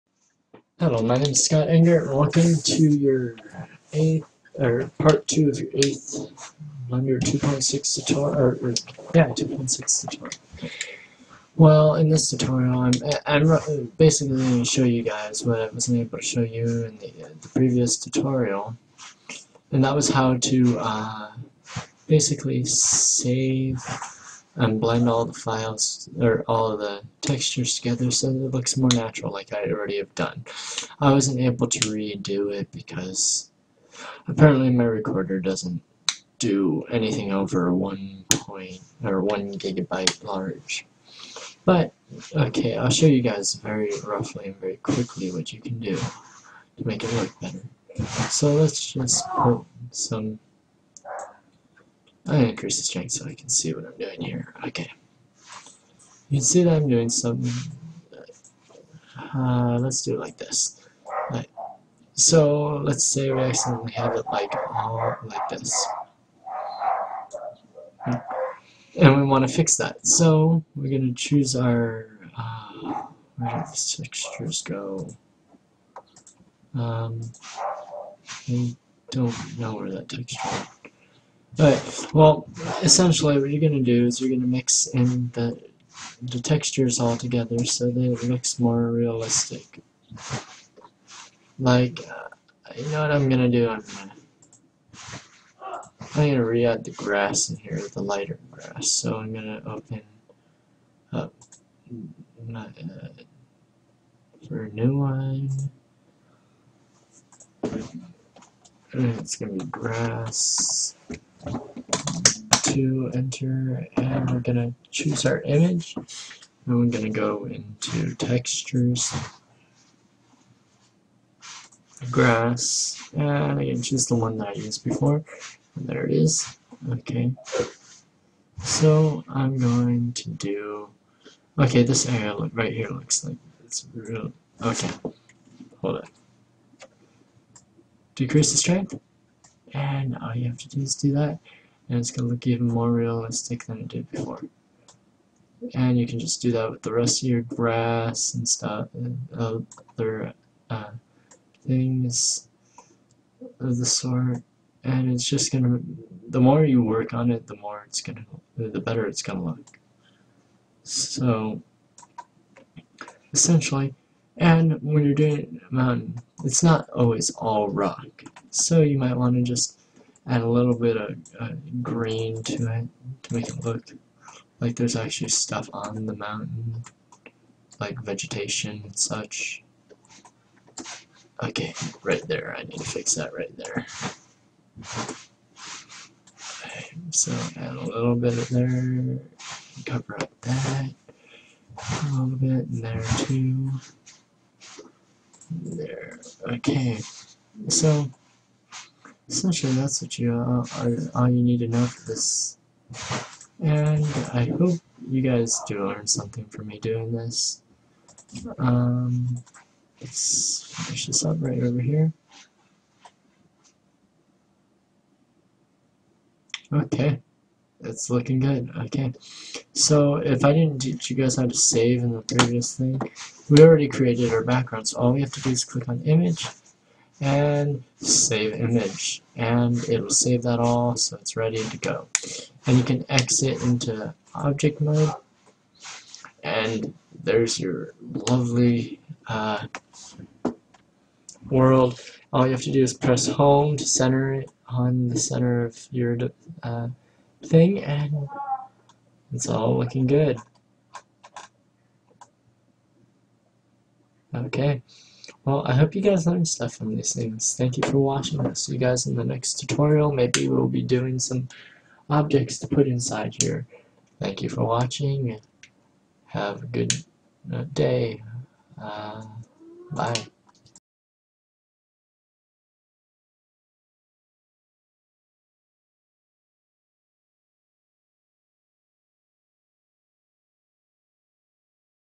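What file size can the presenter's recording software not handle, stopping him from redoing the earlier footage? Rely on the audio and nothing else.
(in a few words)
1 gigabyte.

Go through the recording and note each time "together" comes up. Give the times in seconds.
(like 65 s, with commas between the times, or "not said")
27 s, 87 s.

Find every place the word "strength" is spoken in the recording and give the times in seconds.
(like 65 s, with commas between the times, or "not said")
52 s, 138 s.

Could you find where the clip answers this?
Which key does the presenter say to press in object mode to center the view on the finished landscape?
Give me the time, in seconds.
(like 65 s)
243 s.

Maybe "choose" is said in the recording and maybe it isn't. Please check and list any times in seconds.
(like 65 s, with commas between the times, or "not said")
71 s, 114 s, 123 s.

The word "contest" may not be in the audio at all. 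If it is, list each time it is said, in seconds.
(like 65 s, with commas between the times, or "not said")
not said.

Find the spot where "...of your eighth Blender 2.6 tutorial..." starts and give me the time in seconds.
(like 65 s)
5 s.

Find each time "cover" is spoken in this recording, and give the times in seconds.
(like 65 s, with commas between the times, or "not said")
189 s.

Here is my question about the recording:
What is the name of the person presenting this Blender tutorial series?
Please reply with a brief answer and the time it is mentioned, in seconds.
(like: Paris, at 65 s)
Scott Engert, at 1 s.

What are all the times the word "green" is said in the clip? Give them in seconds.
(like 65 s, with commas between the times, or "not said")
171 s.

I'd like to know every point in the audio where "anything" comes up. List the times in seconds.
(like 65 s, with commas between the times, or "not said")
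36 s.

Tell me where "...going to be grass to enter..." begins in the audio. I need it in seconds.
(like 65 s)
109 s.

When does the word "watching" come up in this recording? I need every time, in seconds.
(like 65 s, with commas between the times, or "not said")
257 s, 264 s.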